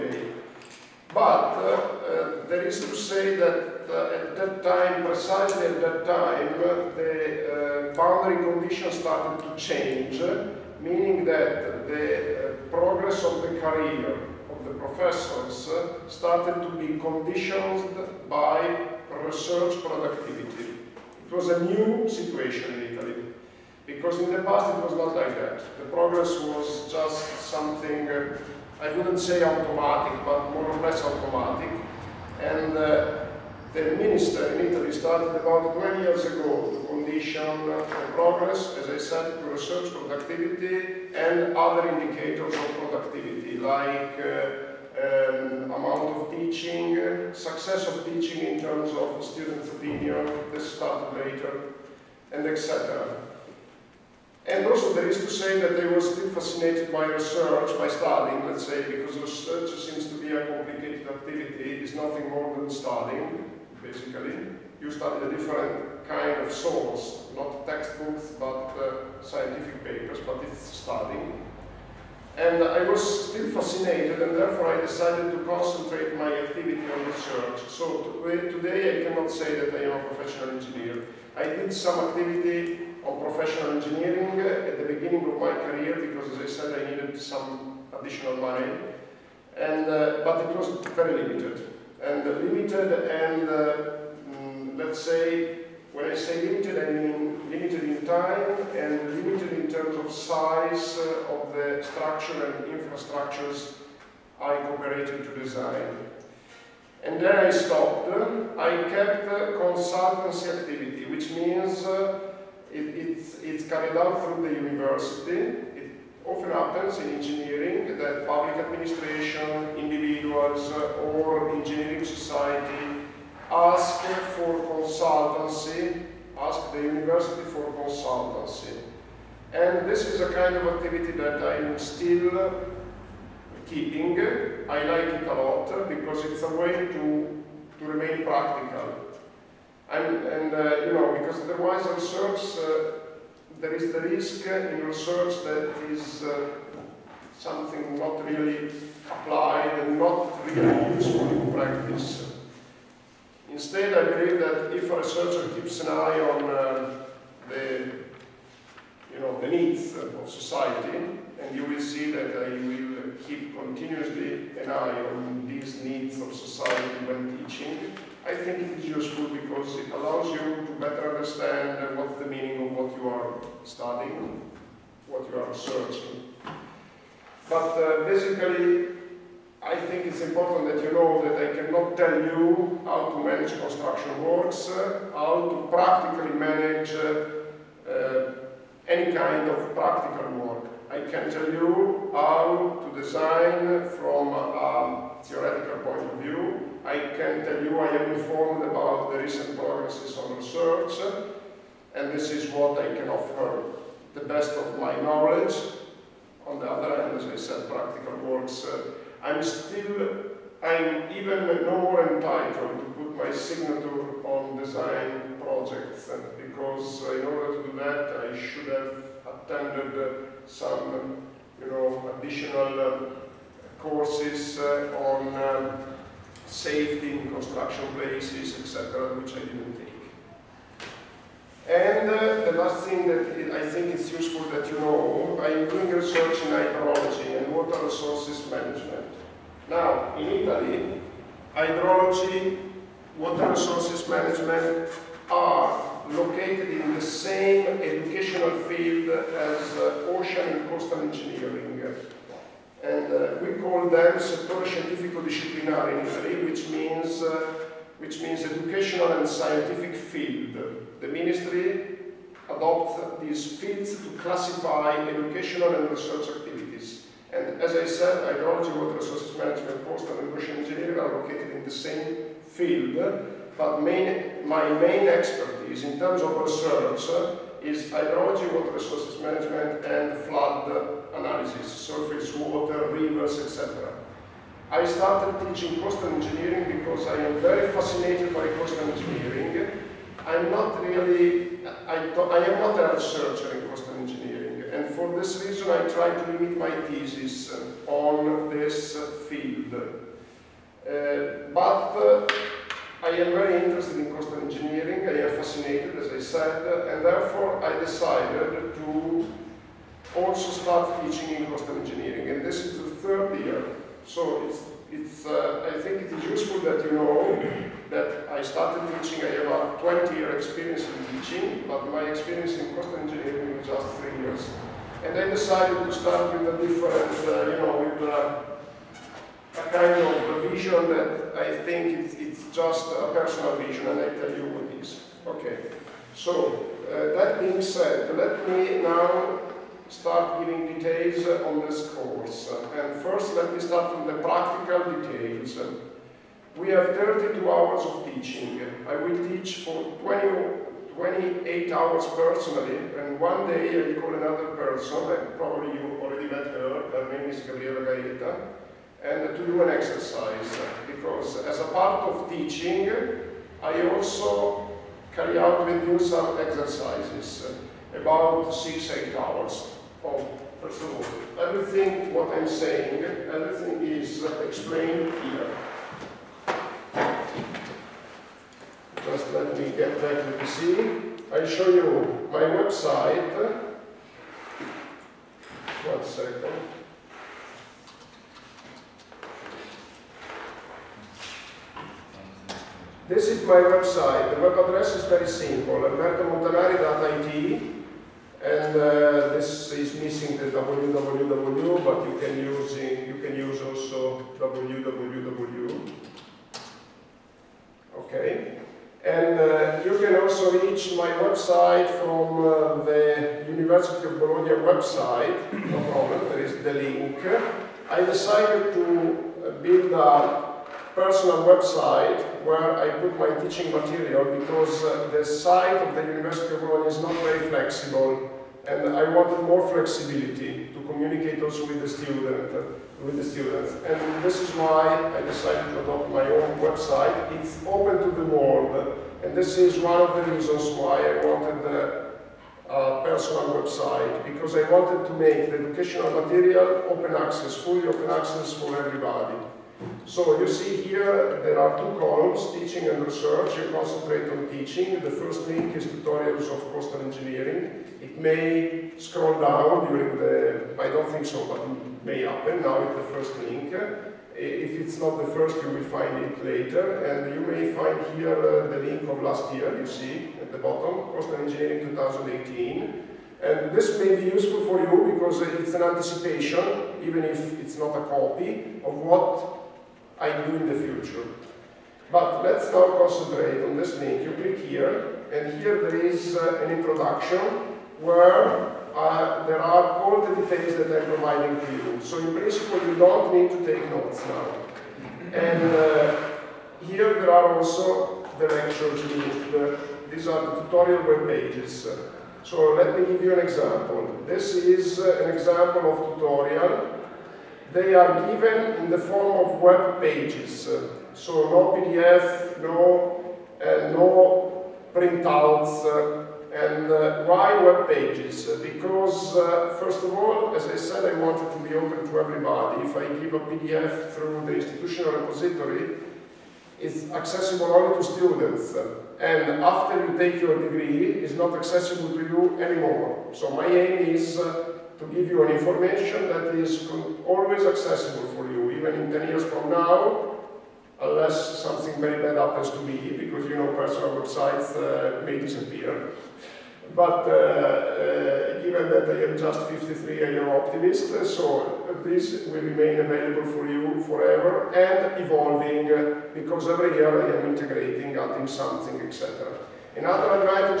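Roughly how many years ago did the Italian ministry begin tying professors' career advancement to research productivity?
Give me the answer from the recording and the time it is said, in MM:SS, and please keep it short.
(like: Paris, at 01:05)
20 years, at 00:35.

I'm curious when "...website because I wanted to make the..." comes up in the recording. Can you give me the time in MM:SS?
07:23.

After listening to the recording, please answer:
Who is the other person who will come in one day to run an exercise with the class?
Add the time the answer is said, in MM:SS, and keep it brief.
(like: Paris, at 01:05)
Gabriella Gaeta, at 05:57.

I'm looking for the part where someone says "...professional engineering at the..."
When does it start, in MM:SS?
01:23.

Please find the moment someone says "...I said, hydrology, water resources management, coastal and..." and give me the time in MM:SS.
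04:27.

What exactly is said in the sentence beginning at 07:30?
So you see here, there are two columns, teaching and research.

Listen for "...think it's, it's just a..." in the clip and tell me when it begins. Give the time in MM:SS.
05:31.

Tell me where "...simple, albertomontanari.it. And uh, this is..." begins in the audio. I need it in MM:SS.
06:35.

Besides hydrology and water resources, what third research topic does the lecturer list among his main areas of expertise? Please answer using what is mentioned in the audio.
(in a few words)
flood analysis.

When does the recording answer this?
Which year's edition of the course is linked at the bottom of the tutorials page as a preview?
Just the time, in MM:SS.
07:51.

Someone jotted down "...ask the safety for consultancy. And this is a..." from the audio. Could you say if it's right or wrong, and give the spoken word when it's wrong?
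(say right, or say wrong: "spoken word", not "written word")
wrong: "university", not "safety".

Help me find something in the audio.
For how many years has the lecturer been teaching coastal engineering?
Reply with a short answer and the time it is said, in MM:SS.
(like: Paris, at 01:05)
3 years, at 05:23.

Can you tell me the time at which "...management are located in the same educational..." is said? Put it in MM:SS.
04:04.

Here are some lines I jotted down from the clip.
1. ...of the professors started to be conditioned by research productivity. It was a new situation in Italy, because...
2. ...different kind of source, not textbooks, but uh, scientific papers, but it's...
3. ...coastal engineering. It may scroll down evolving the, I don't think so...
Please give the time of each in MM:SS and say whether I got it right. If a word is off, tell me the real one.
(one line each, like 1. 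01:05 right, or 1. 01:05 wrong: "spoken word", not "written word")
1. 00:14 right
2. 01:05 right
3. 07:36 wrong: "during", not "evolving".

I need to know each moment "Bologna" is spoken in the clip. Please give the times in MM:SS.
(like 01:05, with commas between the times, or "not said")
06:54, 07:06.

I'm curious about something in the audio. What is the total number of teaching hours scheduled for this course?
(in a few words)
32 hours.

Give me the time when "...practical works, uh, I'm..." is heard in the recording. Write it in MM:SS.
03:27.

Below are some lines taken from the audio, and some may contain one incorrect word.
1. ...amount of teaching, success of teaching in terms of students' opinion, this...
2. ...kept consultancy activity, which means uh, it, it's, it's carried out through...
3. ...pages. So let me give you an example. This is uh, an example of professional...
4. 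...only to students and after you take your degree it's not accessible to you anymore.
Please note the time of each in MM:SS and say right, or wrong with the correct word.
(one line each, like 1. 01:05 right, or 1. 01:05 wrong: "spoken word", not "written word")
1. 00:45 right
2. 01:48 right
3. 08:21 wrong: "tutorial", not "professional"
4. 08:47 right.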